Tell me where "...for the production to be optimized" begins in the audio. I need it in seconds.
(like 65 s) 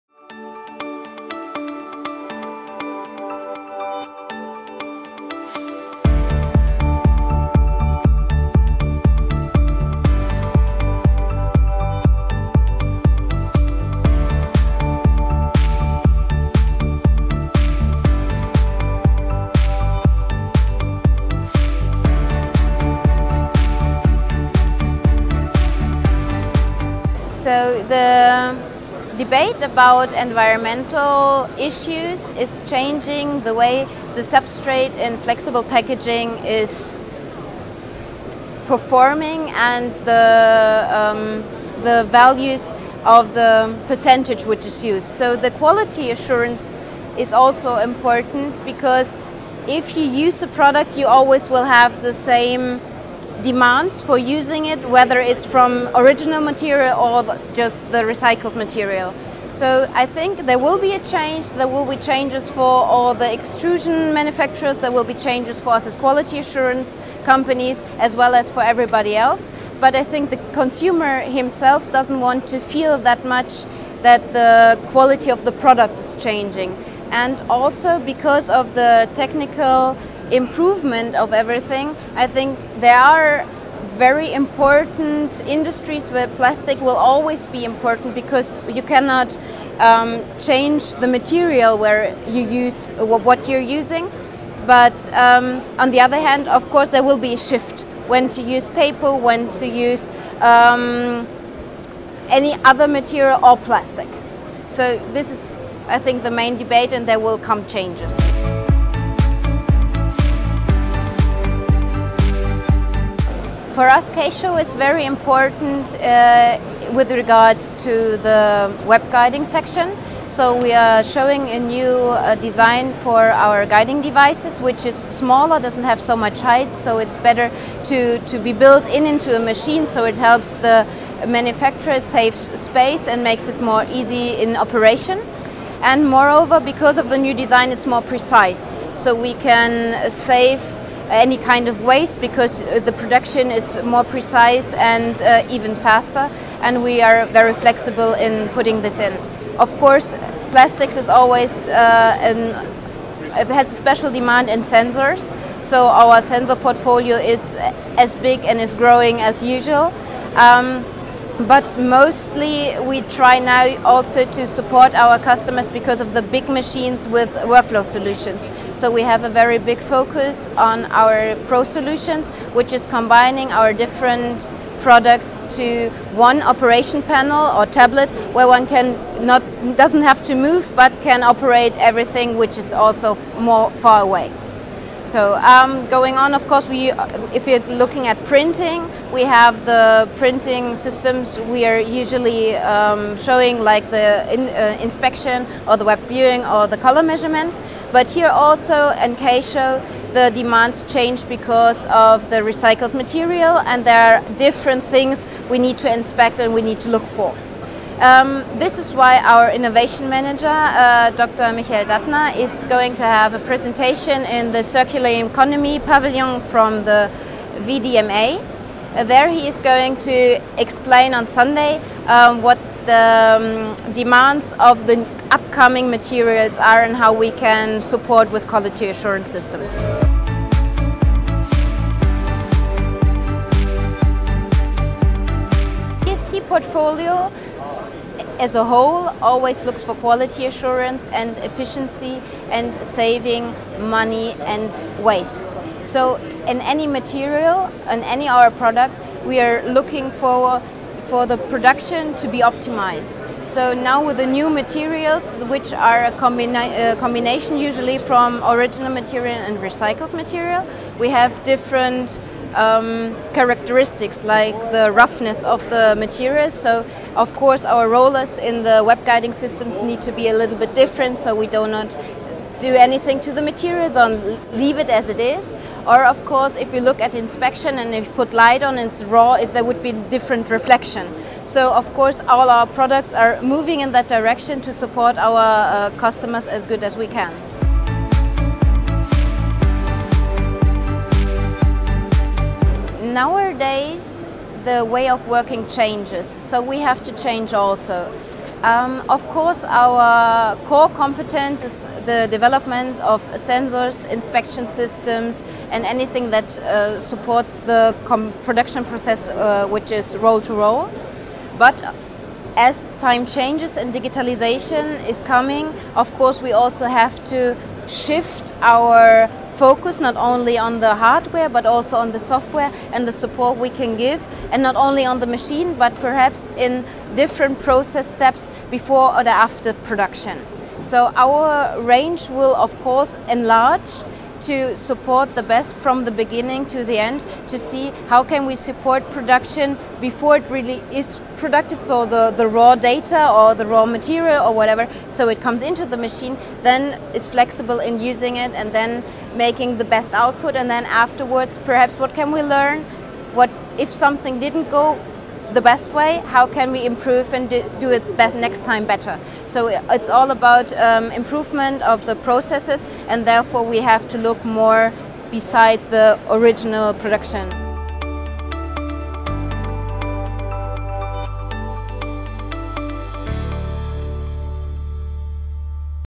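251 s.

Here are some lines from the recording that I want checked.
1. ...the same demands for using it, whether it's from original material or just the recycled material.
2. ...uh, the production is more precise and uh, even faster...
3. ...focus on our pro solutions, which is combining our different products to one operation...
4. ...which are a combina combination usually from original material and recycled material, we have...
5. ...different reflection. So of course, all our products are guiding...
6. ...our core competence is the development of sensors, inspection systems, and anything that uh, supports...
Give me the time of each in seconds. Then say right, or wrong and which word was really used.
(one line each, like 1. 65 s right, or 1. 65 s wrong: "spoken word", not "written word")
1. 52 s right
2. 142 s right
3. 169 s right
4. 255 s right
5. 280 s wrong: "moving", not "guiding"
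6. 299 s right.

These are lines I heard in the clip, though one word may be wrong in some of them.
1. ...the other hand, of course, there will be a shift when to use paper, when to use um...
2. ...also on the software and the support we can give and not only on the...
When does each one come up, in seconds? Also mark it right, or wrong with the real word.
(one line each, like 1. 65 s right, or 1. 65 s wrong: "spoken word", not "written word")
1. 95 s right
2. 321 s right.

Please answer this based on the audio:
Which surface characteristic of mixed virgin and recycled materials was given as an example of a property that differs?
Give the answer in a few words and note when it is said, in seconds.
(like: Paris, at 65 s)
Roughness, at 264 s.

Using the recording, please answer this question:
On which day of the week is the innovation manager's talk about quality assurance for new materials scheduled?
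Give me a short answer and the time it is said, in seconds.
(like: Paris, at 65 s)
Sunday, at 221 s.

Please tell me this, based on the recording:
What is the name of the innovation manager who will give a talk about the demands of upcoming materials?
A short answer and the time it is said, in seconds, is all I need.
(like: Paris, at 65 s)
Dr. Michael Dattner, at 211 s.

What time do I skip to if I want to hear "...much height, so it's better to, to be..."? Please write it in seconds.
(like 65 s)
126 s.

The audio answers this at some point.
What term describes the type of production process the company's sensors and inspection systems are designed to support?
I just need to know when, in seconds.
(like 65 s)
310 s.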